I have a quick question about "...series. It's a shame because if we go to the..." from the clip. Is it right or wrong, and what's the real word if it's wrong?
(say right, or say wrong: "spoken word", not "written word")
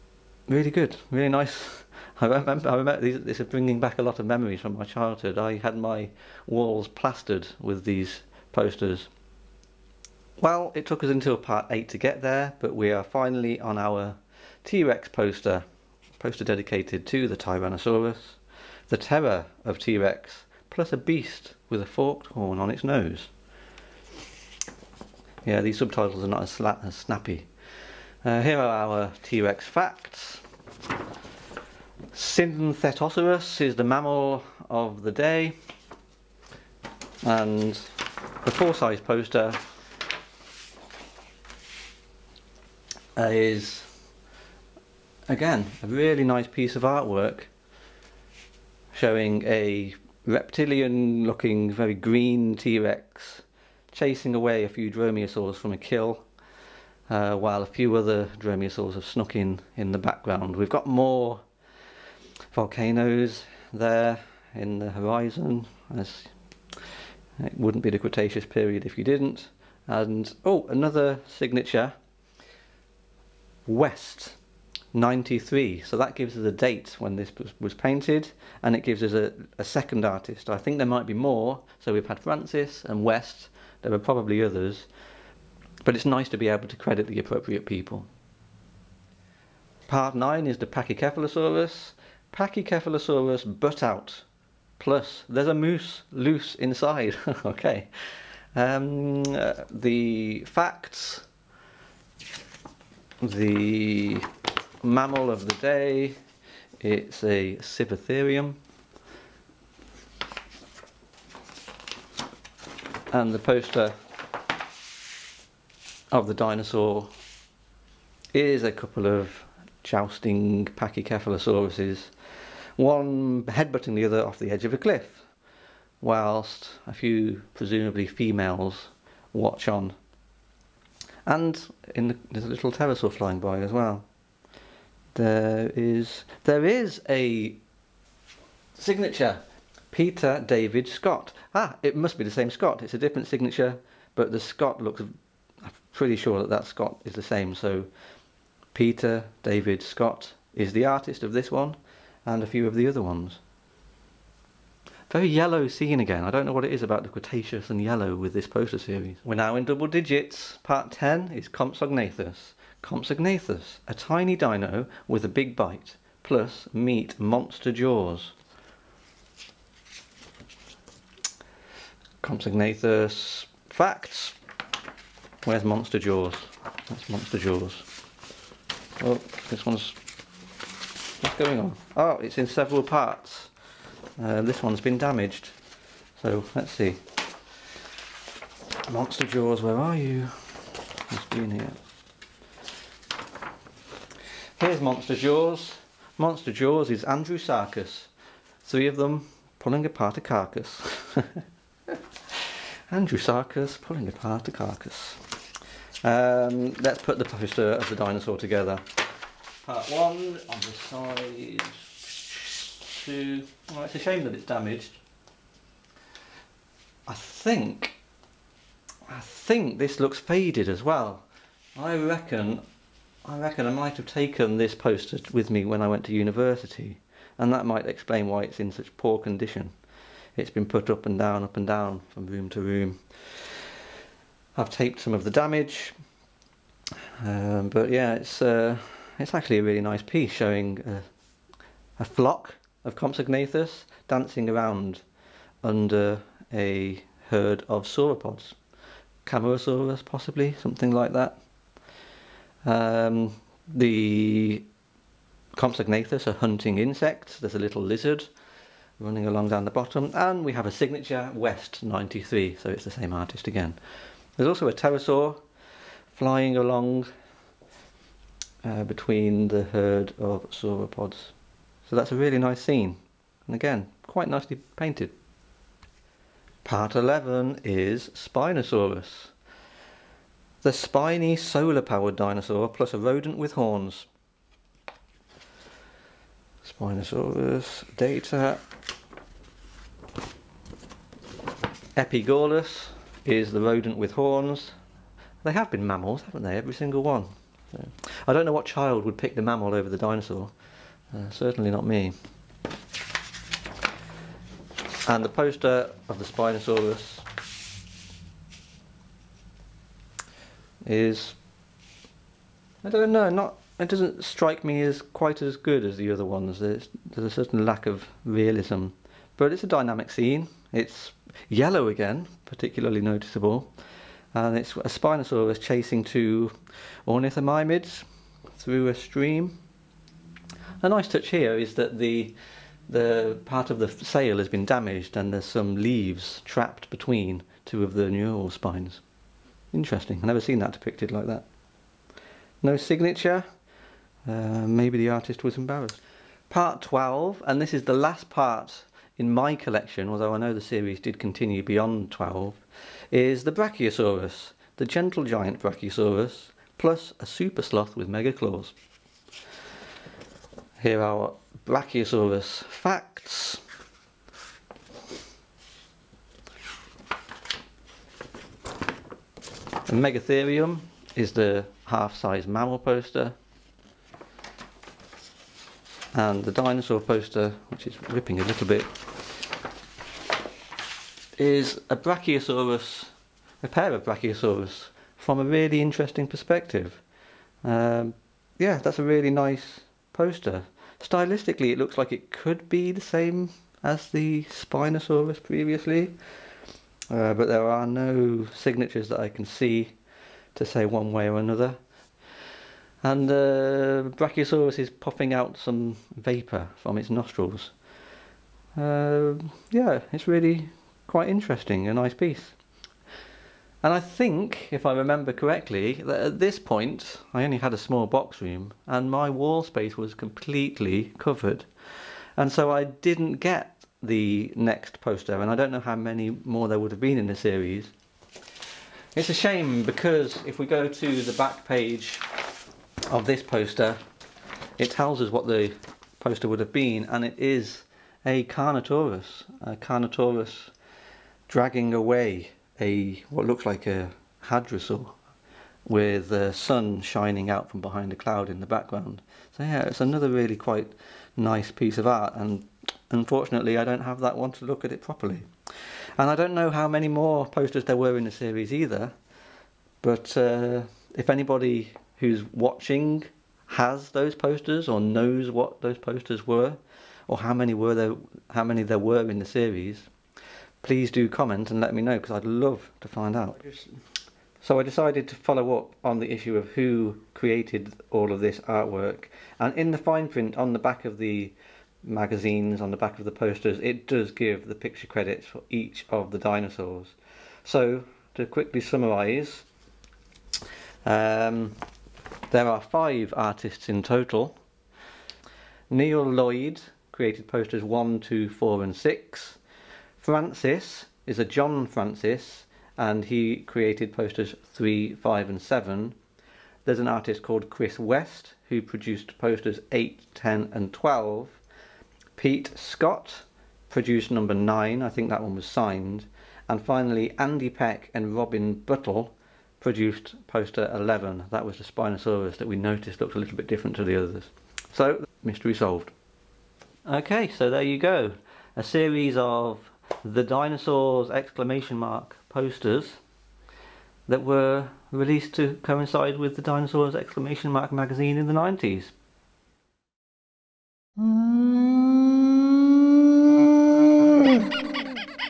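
right.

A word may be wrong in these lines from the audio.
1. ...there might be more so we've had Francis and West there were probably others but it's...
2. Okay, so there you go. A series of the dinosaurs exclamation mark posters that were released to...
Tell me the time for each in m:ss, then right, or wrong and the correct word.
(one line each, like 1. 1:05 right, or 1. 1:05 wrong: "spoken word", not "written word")
1. 1:20 right
2. 8:47 right.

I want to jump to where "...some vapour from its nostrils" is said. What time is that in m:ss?
6:45.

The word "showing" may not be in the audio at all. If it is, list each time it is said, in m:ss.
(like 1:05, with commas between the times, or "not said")
0:49, 4:00.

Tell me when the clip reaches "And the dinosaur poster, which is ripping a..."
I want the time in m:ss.
6:16.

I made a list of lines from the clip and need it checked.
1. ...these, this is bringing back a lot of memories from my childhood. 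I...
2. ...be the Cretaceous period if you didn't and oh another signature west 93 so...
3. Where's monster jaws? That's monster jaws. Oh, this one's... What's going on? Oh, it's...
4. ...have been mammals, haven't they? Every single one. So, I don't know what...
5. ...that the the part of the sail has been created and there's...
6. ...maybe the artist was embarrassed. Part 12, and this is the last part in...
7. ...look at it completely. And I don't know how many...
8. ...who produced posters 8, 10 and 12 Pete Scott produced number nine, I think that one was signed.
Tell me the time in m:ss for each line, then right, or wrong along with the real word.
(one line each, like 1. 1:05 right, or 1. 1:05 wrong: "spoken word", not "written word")
1. 0:03 right
2. 1:07 right
3. 2:55 right
4. 4:55 right
5. 5:31 wrong: "damaged", not "created"
6. 5:44 right
7. 7:34 wrong: "properly", not "completely"
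8. 8:28 right.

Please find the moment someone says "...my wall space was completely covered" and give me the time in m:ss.
6:59.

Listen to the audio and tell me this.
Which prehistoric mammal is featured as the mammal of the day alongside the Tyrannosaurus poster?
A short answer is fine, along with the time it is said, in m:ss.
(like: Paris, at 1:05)
Synthetoceras, at 0:32.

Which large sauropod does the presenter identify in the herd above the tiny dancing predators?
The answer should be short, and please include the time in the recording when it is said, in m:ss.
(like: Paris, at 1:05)
Camarasaurus, at 4:09.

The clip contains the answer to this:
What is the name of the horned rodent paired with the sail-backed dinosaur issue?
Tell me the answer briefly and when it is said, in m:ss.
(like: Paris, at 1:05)
Epigaulus, at 4:51.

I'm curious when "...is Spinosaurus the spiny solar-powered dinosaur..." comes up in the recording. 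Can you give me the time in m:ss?
4:37.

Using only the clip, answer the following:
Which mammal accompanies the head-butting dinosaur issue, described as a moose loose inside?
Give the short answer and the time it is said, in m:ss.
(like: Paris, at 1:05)
Sivatherium, at 1:47.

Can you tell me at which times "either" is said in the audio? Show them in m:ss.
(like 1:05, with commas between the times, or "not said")
7:38.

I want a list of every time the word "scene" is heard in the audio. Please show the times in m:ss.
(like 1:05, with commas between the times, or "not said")
2:35, 4:32, 5:20.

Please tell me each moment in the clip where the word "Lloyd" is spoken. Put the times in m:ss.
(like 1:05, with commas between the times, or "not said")
8:16.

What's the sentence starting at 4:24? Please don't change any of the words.
There's also a pterosaur flying along uh, between the herd of sauropods.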